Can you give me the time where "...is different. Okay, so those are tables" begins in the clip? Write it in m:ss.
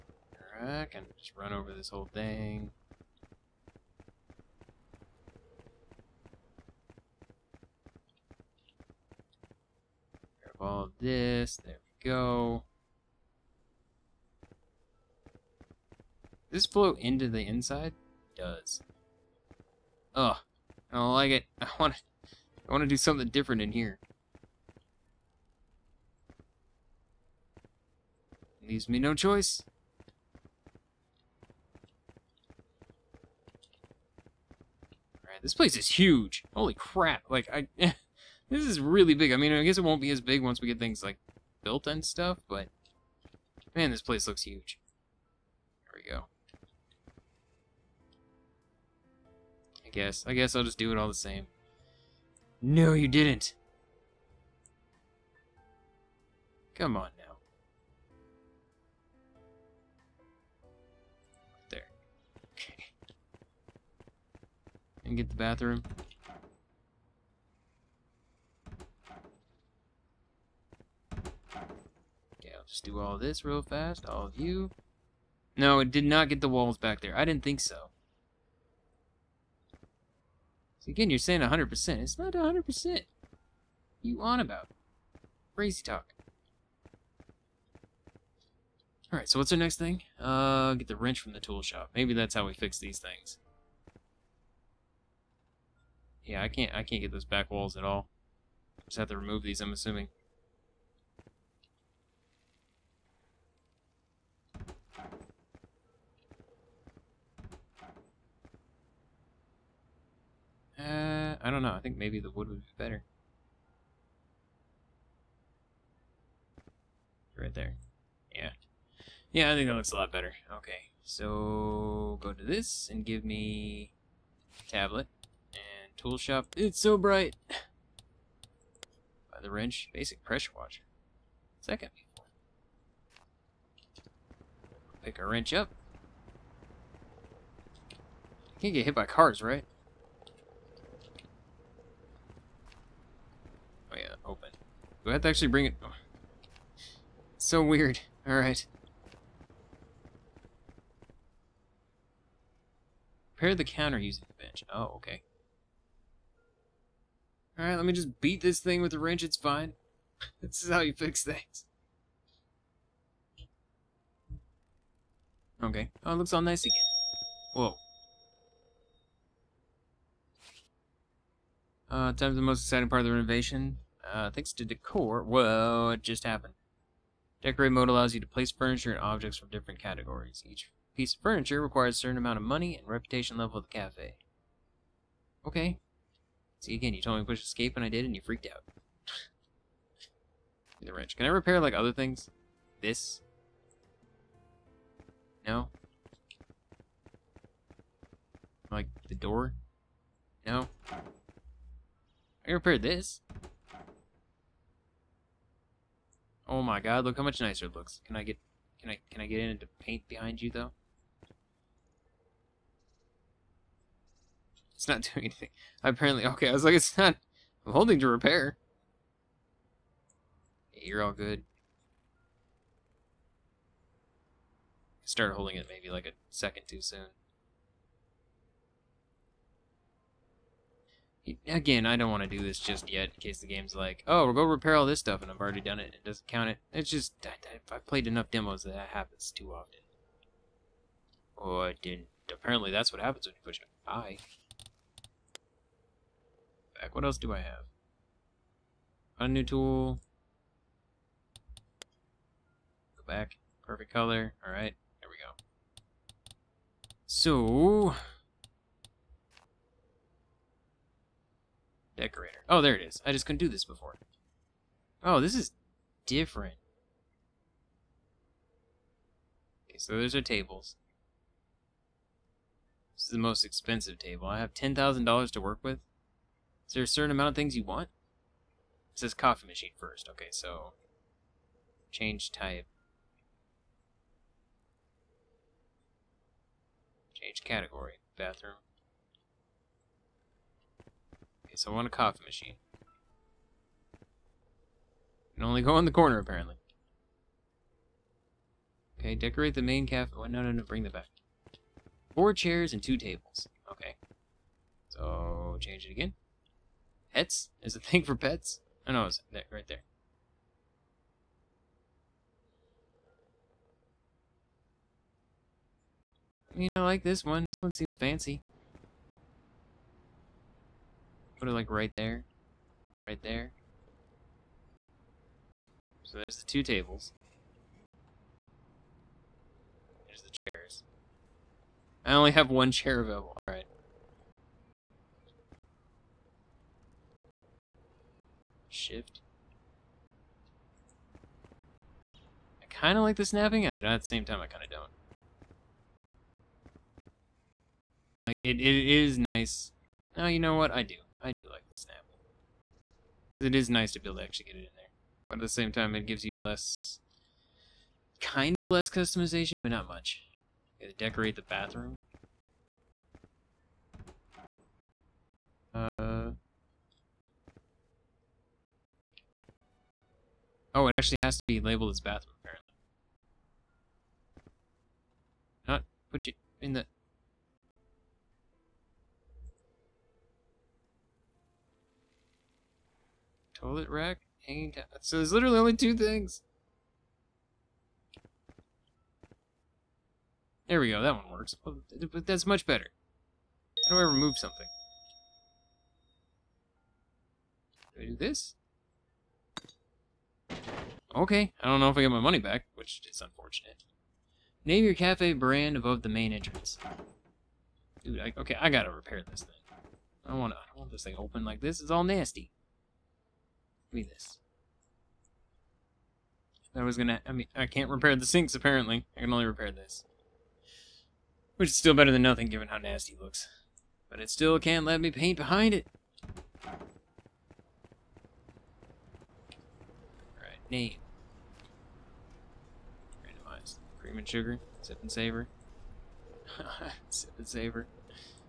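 4:25.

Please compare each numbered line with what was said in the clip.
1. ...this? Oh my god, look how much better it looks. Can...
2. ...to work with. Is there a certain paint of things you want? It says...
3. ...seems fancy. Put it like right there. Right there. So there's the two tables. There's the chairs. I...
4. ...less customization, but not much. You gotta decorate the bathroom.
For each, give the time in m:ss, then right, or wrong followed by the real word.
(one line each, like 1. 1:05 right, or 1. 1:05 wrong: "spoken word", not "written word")
1. 3:22 wrong: "nicer", not "better"
2. 4:35 wrong: "amount", not "paint"
3. 5:17 right
4. 5:58 right.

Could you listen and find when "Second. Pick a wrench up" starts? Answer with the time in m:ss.
2:11.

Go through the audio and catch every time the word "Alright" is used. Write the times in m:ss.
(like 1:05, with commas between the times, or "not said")
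0:35, 1:29, 2:28, 2:37, 4:14, 5:33.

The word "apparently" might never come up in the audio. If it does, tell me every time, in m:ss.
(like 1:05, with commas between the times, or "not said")
3:35, 4:02, 4:56, 6:12, 6:58.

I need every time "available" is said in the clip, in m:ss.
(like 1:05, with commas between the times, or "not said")
5:33.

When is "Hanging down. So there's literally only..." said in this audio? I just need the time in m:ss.
6:24.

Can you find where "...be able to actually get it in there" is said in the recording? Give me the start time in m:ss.
5:53.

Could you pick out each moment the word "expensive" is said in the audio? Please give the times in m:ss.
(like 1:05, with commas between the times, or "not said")
4:33.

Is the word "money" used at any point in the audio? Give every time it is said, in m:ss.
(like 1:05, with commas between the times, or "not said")
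3:02, 6:42.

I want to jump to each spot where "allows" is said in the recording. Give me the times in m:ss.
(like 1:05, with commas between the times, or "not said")
2:57.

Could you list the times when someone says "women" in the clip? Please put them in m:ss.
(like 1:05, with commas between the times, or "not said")
not said.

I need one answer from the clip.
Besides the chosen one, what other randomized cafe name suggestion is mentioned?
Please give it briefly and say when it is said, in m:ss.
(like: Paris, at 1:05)
Cream and Sugar, at 7:13.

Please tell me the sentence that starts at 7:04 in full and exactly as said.
But it still can't let me paint behind it.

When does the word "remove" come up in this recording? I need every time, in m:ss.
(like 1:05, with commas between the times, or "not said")
1:39, 6:34.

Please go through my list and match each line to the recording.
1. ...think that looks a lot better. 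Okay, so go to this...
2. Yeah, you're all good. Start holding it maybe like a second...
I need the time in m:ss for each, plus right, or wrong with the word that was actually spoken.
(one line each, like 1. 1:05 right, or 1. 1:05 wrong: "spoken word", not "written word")
1. 1:59 right
2. 3:40 right.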